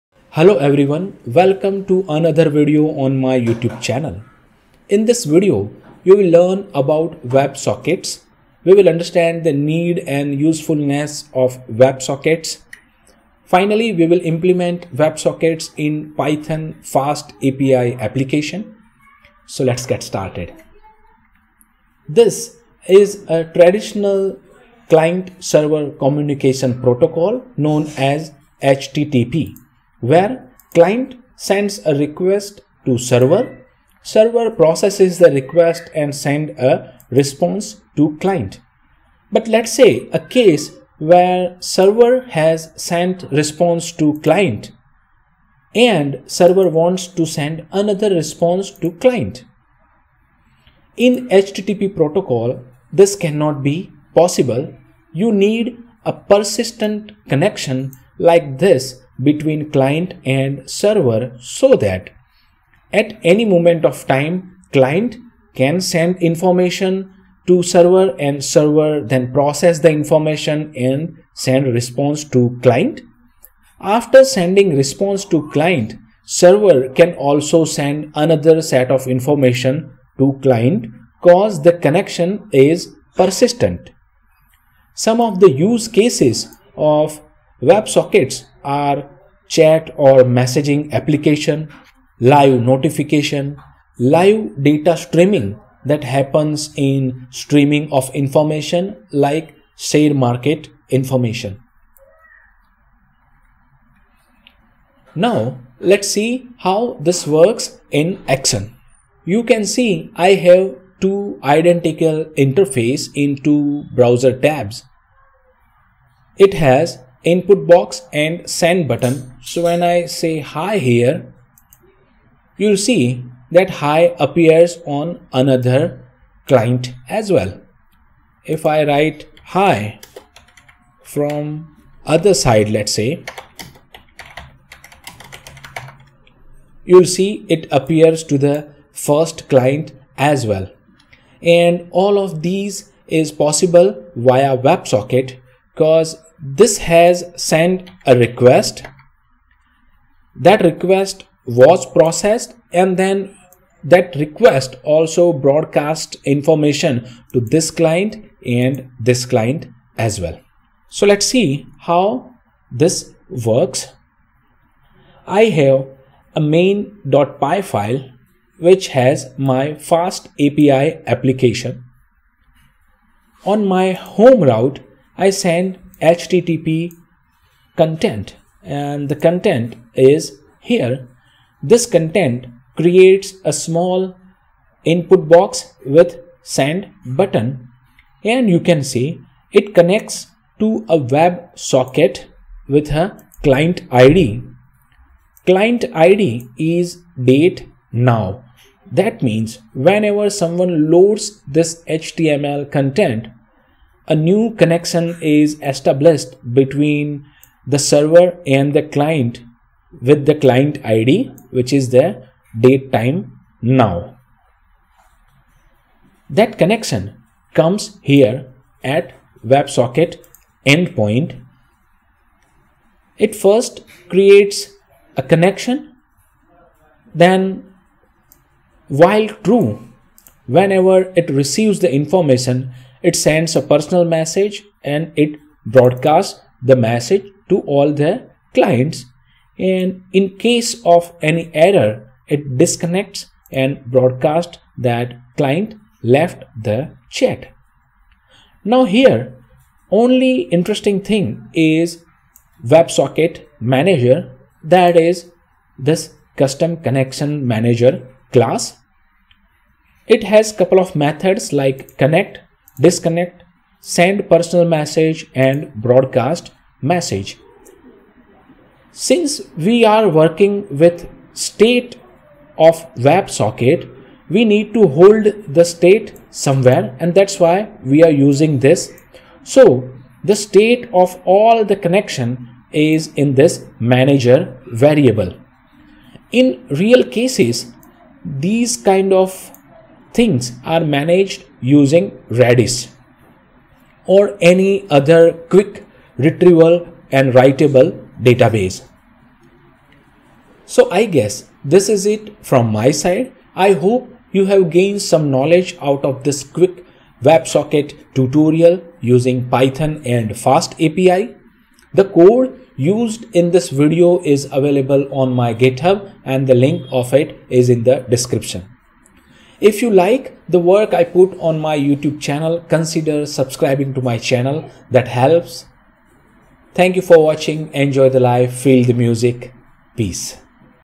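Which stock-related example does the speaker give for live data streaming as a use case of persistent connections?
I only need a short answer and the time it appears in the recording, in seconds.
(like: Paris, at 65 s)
share market information, at 99 s.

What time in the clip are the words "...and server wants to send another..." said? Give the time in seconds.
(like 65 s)
45 s.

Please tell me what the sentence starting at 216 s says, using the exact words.
That connection comes here at WebSocket endpoint.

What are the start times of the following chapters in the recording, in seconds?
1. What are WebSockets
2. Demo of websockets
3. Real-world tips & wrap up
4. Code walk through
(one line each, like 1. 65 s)
1. 22 s
2. 110 s
3. 300 s
4. 161 s.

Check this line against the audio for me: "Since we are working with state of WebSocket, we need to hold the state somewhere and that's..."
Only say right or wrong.
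right.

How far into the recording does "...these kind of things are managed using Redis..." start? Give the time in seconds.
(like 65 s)
288 s.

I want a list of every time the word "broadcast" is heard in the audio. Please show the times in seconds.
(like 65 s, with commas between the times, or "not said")
155 s, 235 s, 243 s, 265 s.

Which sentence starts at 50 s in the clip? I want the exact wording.
In HTTP protocol, this cannot be possible.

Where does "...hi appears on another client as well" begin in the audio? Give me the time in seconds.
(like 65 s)
123 s.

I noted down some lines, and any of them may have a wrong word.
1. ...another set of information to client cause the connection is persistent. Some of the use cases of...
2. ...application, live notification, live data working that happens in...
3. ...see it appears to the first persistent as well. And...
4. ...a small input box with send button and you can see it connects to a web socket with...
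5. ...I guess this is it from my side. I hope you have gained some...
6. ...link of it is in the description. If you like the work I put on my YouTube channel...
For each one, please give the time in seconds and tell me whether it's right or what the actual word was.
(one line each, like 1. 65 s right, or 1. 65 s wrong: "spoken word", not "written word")
1. 78 s right
2. 90 s wrong: "streaming", not "working"
3. 137 s wrong: "client", not "persistent"
4. 183 s right
5. 300 s right
6. 316 s right.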